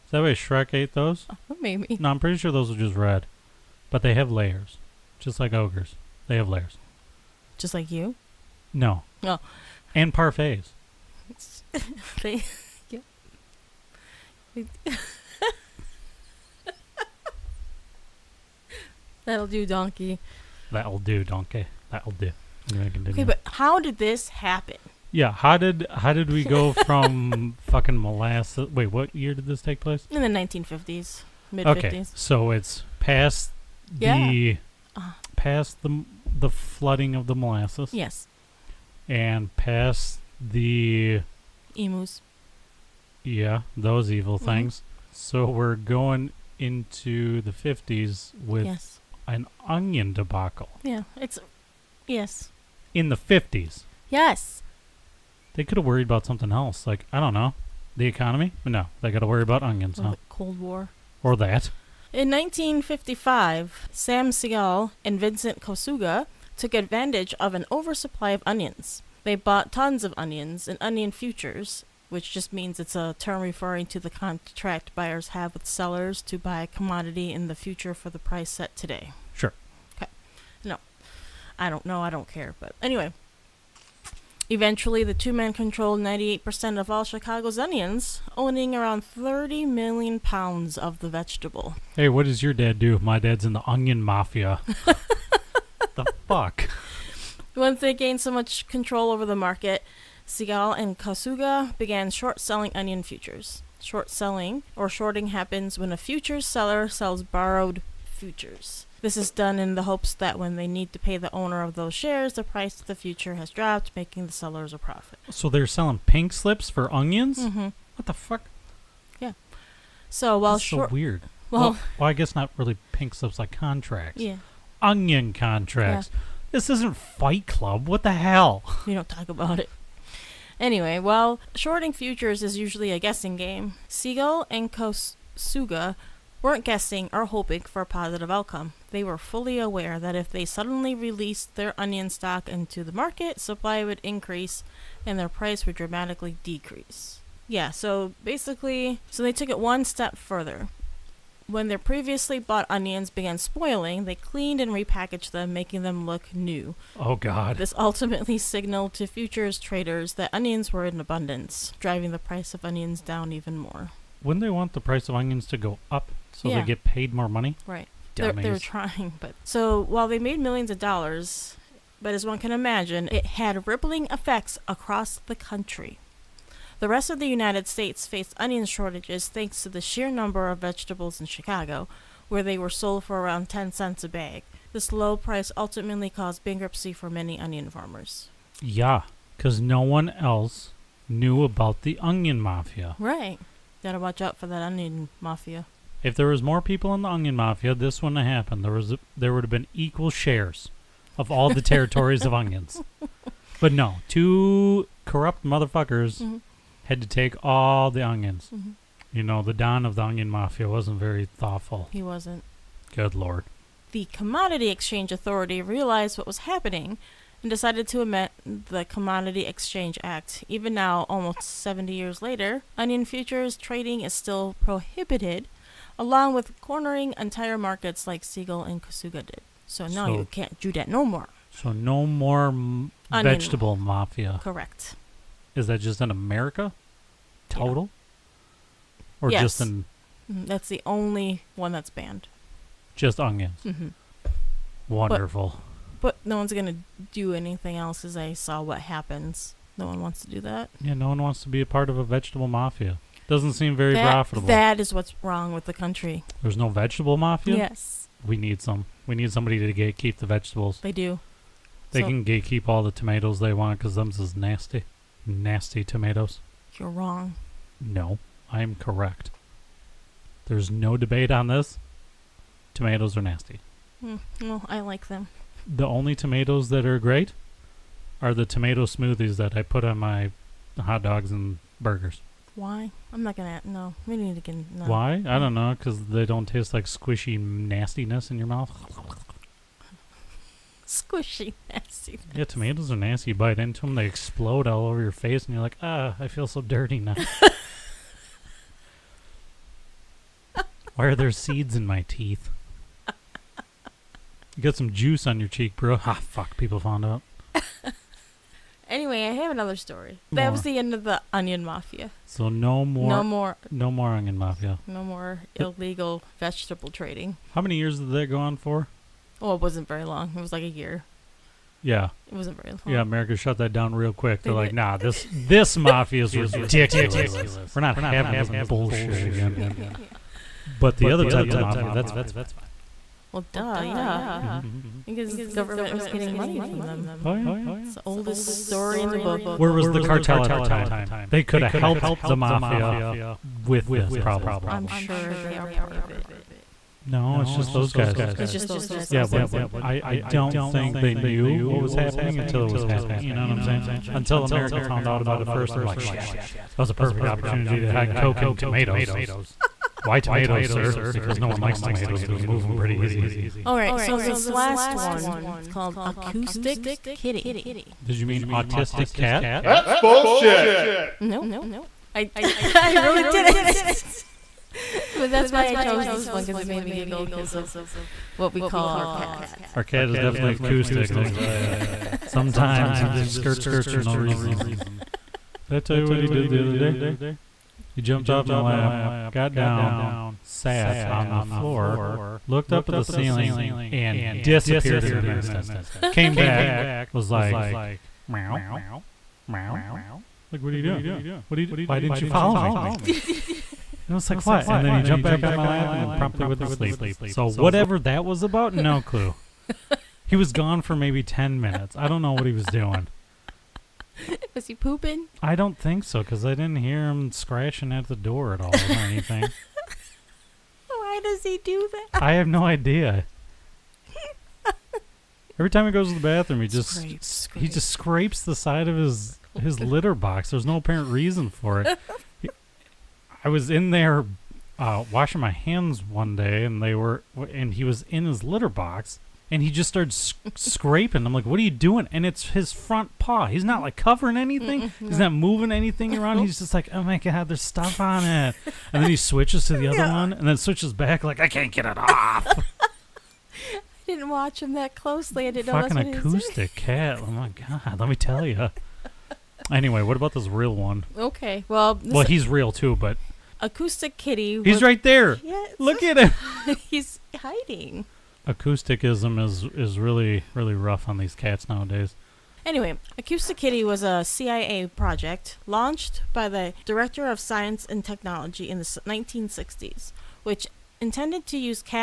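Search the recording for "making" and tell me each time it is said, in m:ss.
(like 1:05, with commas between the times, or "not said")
1:53, 2:35.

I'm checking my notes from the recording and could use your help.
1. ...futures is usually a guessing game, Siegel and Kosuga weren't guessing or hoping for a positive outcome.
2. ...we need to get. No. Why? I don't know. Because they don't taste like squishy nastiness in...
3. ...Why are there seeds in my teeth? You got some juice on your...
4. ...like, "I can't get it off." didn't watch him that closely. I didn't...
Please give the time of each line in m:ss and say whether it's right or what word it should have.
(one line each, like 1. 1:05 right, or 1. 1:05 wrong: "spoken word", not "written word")
1. 2:11 right
2. 4:44 right
3. 5:00 right
4. 7:31 right.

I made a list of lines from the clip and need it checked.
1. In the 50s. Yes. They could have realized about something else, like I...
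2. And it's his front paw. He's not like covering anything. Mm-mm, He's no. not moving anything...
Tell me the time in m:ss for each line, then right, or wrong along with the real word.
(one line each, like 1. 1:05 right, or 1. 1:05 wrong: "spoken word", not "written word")
1. 0:52 wrong: "worried", not "realized"
2. 7:22 right.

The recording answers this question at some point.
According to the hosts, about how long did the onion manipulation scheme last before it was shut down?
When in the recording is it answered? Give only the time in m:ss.
5:20.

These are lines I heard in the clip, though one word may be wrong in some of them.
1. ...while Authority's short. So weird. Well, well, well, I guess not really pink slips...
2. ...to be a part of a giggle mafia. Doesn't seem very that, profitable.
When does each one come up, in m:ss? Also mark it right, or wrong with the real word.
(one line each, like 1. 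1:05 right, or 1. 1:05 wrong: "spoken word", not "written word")
1. 2:00 wrong: "That", not "Authority"
2. 4:11 wrong: "vegetable", not "giggle".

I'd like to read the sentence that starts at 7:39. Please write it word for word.
anyway, what about this real one?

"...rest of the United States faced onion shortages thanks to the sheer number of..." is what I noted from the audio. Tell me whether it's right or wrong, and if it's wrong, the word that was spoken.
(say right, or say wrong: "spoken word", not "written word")
right.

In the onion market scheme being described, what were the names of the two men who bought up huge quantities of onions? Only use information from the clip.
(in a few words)
Sam Siegel and Vincent Kosuga.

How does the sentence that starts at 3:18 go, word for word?
There was a, there would have been equal shares of all the territories of onions.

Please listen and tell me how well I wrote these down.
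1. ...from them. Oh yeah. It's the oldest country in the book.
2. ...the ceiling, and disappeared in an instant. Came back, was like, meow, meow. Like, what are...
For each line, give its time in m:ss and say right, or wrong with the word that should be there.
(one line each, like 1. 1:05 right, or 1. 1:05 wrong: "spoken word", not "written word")
1. 5:36 wrong: "story", not "country"
2. 6:32 right.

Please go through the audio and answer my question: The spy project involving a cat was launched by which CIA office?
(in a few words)
Director of Science and Technology.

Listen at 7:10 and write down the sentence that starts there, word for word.
There's no apparent reason for it.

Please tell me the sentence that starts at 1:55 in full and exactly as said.
So they're selling pink slips for onions?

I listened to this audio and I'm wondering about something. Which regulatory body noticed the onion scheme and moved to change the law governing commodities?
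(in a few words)
The Commodity Exchange Authority.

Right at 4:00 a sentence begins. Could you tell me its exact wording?
That's the only one that's banned.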